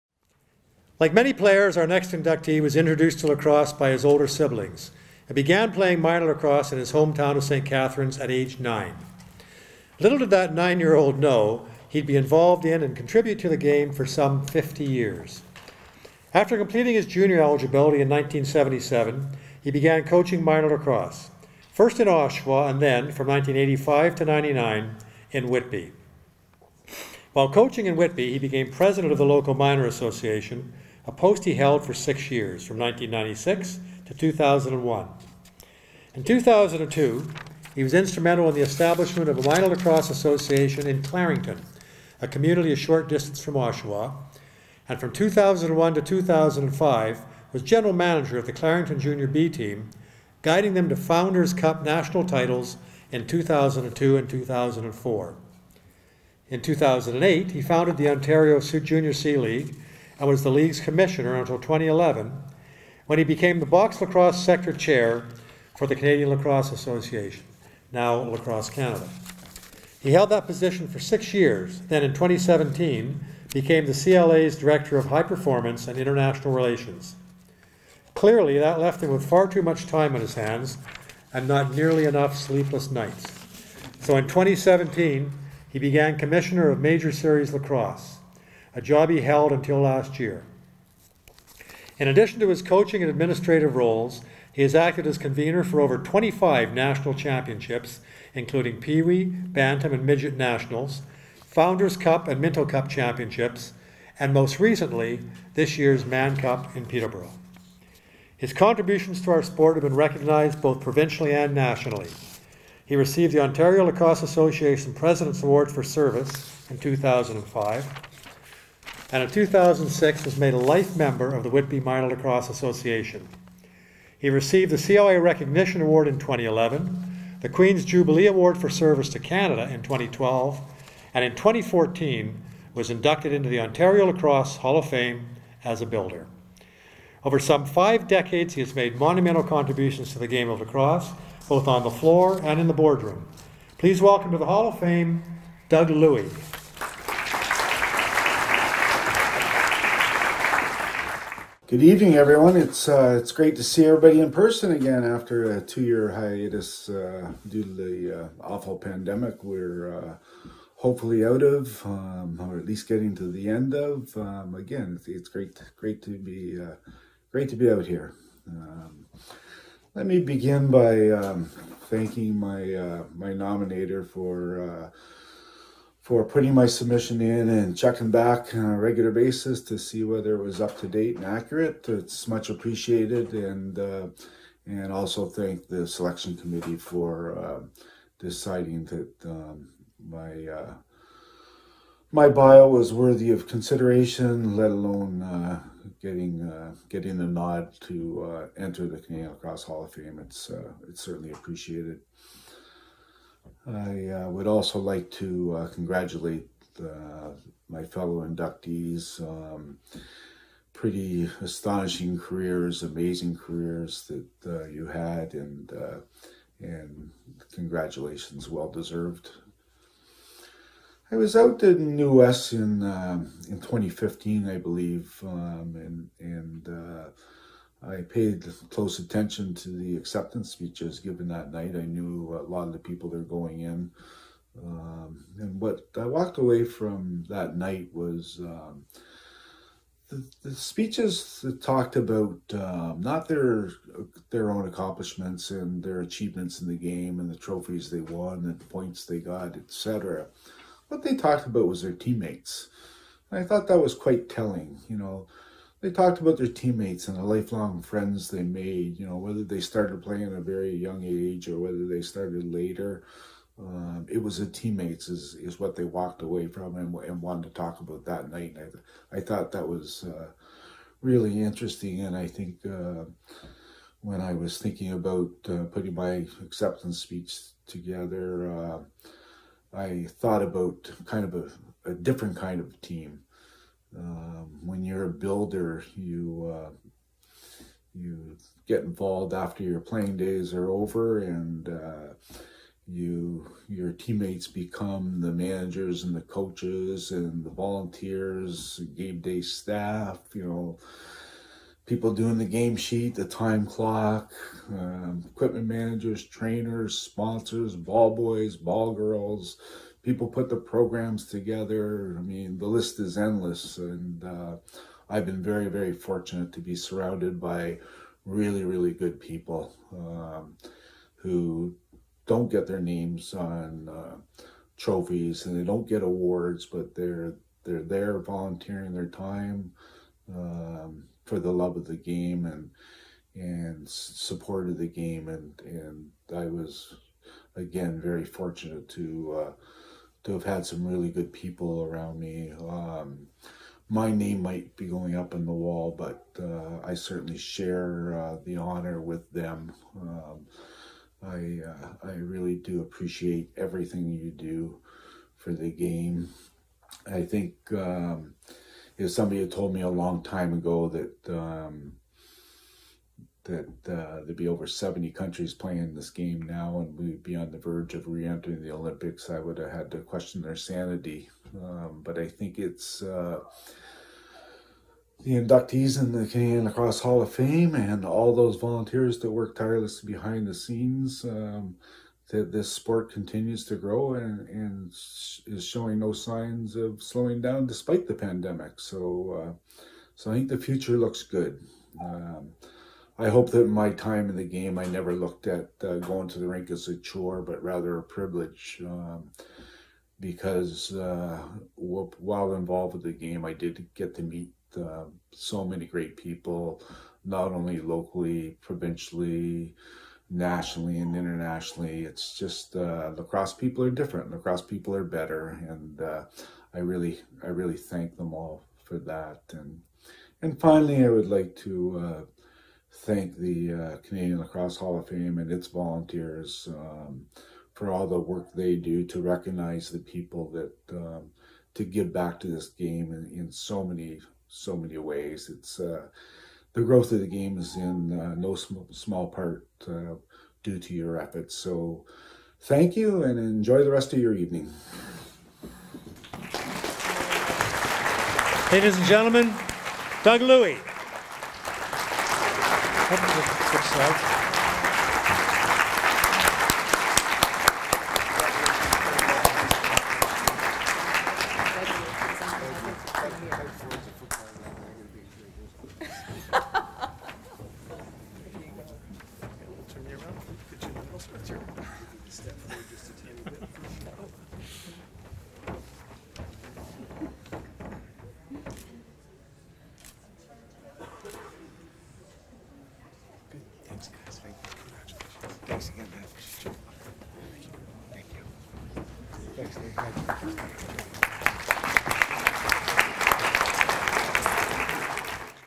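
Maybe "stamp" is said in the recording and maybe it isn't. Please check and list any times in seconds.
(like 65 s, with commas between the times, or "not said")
not said.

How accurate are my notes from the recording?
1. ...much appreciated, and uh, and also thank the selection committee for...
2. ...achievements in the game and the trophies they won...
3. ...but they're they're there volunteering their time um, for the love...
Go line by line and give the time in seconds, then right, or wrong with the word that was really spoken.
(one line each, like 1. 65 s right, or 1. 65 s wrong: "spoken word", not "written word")
1. 182 s right
2. 246 s right
3. 326 s right.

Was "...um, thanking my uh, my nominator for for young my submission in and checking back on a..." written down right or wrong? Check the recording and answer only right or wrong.
wrong.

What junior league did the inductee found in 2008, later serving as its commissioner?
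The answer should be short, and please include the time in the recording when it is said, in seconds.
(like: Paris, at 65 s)
Ontario Junior C League, at 58 s.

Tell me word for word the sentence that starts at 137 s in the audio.
Over some five decades, he has made monumental contributions to the game of lacrosse, both on the floor and in the boardroom.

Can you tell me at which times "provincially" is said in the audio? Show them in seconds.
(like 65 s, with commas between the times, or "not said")
110 s, 408 s.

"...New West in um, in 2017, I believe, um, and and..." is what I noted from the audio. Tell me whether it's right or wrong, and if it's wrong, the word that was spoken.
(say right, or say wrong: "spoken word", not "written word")
wrong: "2015", not "2017".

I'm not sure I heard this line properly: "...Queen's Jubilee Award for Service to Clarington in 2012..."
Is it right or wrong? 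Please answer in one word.
wrong.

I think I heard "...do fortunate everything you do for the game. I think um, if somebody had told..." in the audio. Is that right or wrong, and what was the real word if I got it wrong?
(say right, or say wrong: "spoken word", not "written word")
wrong: "appreciate", not "fortunate".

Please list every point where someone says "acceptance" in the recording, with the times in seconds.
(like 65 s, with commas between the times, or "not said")
229 s, 276 s.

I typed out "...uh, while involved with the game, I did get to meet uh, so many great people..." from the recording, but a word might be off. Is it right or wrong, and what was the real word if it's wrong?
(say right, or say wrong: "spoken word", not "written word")
right.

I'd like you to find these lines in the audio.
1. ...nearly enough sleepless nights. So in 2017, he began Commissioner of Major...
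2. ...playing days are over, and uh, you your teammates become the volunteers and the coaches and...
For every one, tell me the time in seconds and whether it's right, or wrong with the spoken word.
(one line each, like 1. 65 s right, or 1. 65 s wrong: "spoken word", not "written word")
1. 81 s right
2. 289 s wrong: "managers", not "volunteers".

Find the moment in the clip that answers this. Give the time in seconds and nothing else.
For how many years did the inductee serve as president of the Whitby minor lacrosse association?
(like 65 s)
31 s.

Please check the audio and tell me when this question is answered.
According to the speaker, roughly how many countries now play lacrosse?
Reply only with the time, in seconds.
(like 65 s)
364 s.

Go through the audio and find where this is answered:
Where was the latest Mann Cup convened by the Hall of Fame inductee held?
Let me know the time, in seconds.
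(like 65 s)
106 s.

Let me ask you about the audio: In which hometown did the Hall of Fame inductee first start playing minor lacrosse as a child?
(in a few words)
St. Catharines.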